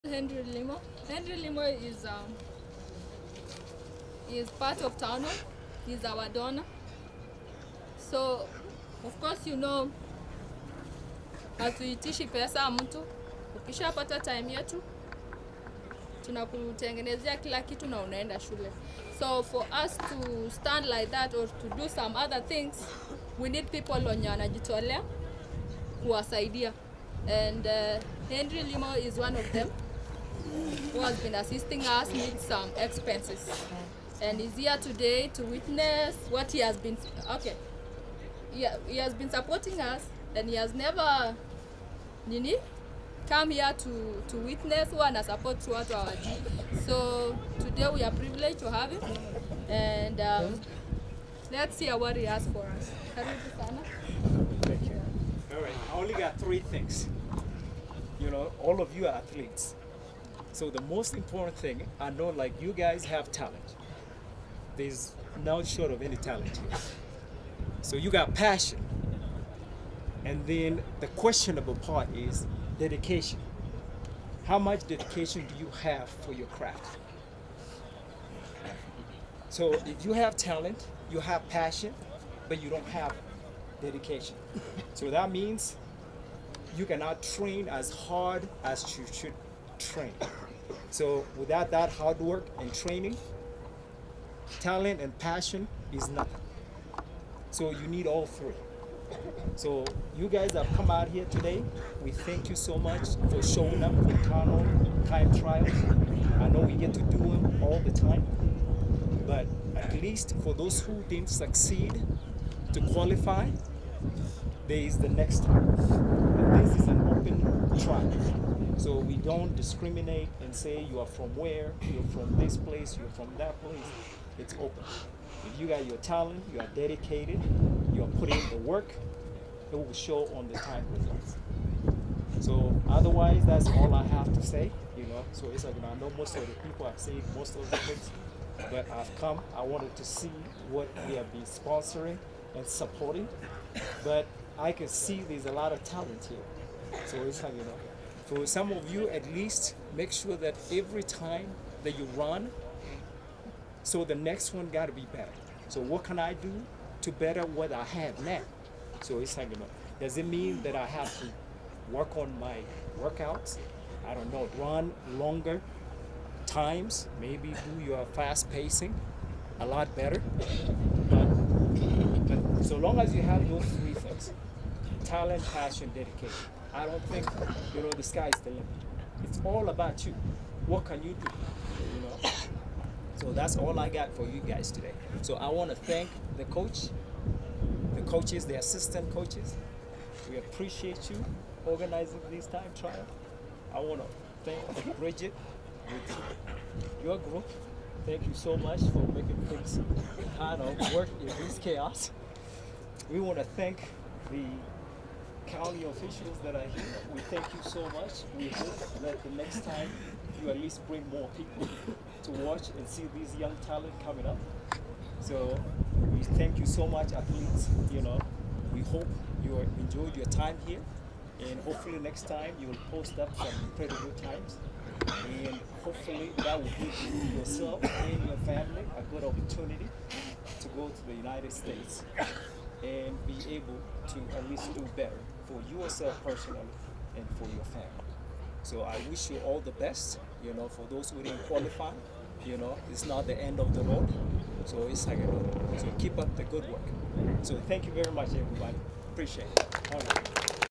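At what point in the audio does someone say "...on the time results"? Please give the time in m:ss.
2:10.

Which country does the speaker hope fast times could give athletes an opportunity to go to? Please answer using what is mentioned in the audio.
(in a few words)
United States.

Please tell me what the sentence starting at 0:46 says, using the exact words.
So today we are privileged to have him and um, let's hear what he has for us.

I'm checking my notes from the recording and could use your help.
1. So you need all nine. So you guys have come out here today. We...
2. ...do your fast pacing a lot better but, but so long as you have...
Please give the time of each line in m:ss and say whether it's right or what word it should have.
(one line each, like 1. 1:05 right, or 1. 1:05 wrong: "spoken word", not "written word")
1. 1:37 wrong: "three", not "nine"
2. 2:47 right.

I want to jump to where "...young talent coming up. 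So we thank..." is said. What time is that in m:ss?
3:33.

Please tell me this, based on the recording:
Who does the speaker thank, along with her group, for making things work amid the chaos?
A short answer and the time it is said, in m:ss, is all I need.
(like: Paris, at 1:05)
Bridget, at 3:14.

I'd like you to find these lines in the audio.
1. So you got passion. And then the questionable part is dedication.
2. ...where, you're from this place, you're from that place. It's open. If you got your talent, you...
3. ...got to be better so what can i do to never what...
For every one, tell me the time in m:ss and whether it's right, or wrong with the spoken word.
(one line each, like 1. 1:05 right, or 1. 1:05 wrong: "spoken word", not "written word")
1. 1:07 right
2. 2:01 right
3. 2:34 wrong: "better", not "never".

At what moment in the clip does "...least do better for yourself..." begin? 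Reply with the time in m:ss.
3:54.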